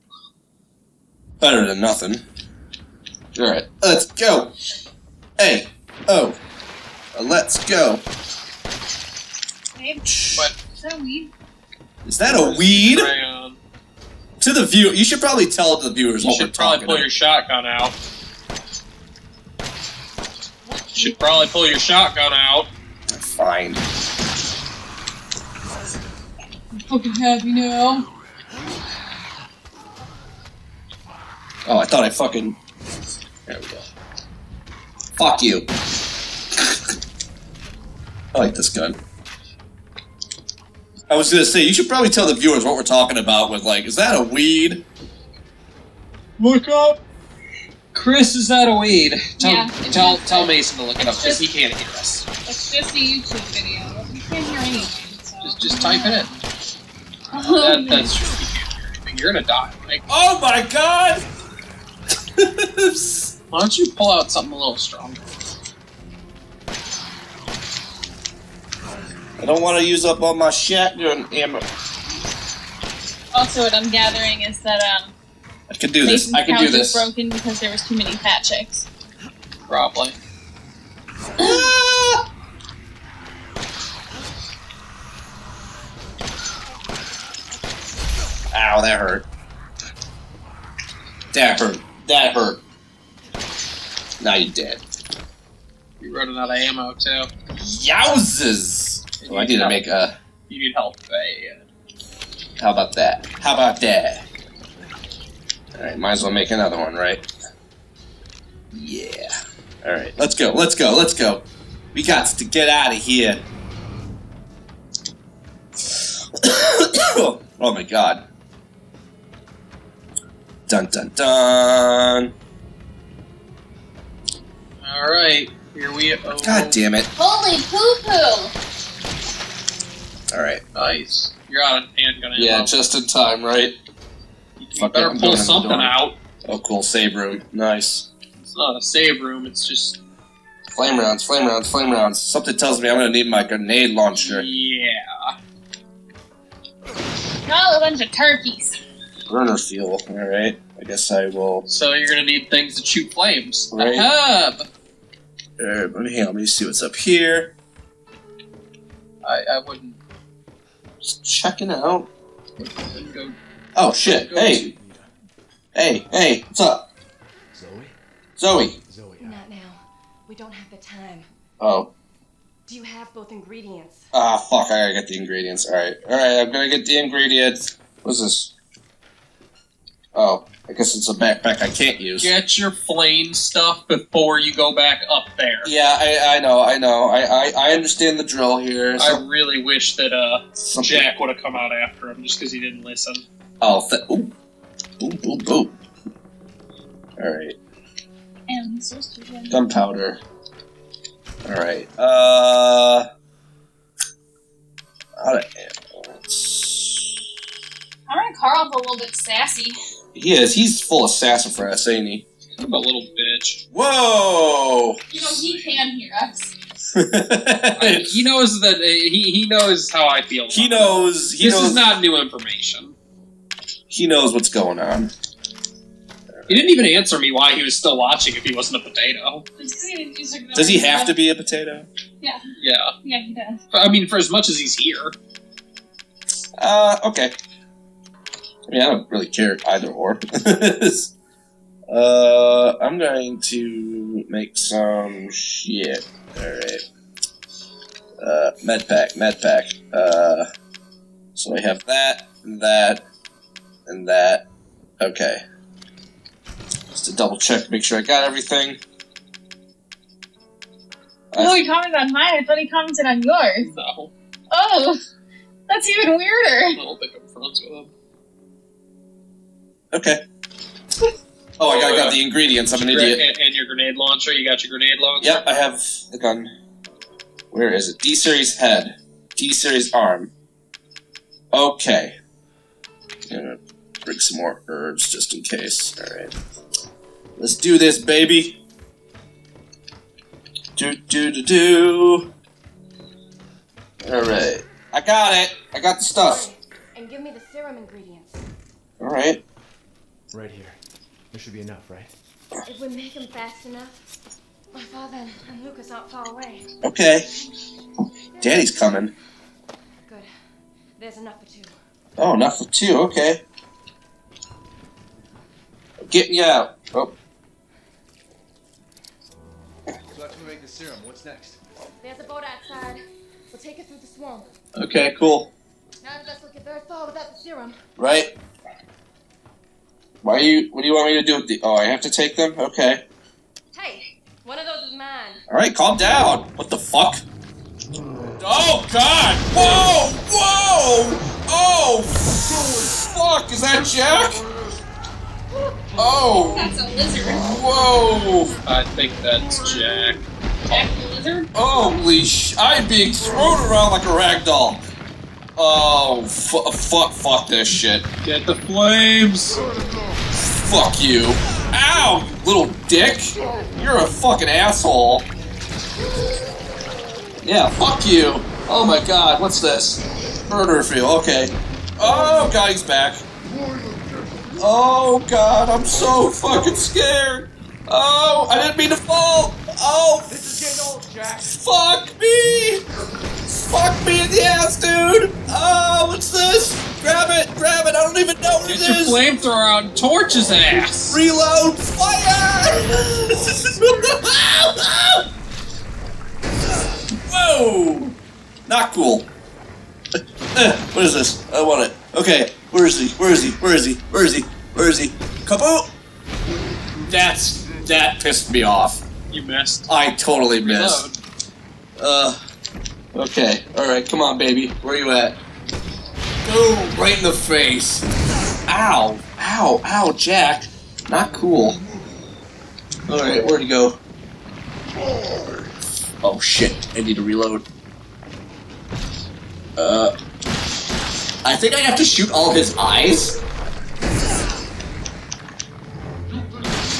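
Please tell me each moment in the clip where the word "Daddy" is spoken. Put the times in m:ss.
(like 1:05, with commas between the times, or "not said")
5:08.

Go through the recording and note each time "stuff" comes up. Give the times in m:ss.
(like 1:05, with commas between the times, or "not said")
3:03, 4:56.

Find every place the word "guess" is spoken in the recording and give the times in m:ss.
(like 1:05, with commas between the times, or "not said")
2:30, 3:00.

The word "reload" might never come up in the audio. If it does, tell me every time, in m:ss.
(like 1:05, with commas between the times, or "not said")
6:31, 6:51, 7:07.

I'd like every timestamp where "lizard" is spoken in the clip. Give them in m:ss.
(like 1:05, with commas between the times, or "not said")
5:46, 5:51.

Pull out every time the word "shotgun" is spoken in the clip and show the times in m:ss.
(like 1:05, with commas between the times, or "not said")
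0:17, 0:21, 1:10.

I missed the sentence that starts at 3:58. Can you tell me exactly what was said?
I mean, I don't really care either or.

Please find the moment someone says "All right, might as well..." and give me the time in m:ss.
1:45.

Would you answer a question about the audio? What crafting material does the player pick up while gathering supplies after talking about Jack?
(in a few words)
Gunpowder.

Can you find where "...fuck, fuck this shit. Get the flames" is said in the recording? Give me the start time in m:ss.
5:56.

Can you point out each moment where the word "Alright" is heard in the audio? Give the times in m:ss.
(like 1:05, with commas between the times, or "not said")
0:03, 3:17, 3:21, 4:06, 7:03.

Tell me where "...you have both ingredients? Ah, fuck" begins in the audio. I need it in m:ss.
2:52.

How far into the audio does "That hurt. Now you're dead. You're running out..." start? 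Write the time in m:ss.
1:32.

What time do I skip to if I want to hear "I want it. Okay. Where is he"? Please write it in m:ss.
6:41.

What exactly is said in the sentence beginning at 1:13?
Also, what I'm gathering is that um, I can do this.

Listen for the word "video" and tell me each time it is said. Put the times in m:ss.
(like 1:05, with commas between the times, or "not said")
0:53.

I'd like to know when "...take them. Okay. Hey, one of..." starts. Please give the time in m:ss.
5:32.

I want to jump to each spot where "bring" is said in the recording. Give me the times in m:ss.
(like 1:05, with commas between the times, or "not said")
4:44.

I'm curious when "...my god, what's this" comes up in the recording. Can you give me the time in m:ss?
6:08.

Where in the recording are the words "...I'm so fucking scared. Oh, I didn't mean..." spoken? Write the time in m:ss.
6:15.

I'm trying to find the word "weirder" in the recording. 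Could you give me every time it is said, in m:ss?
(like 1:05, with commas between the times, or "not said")
4:26.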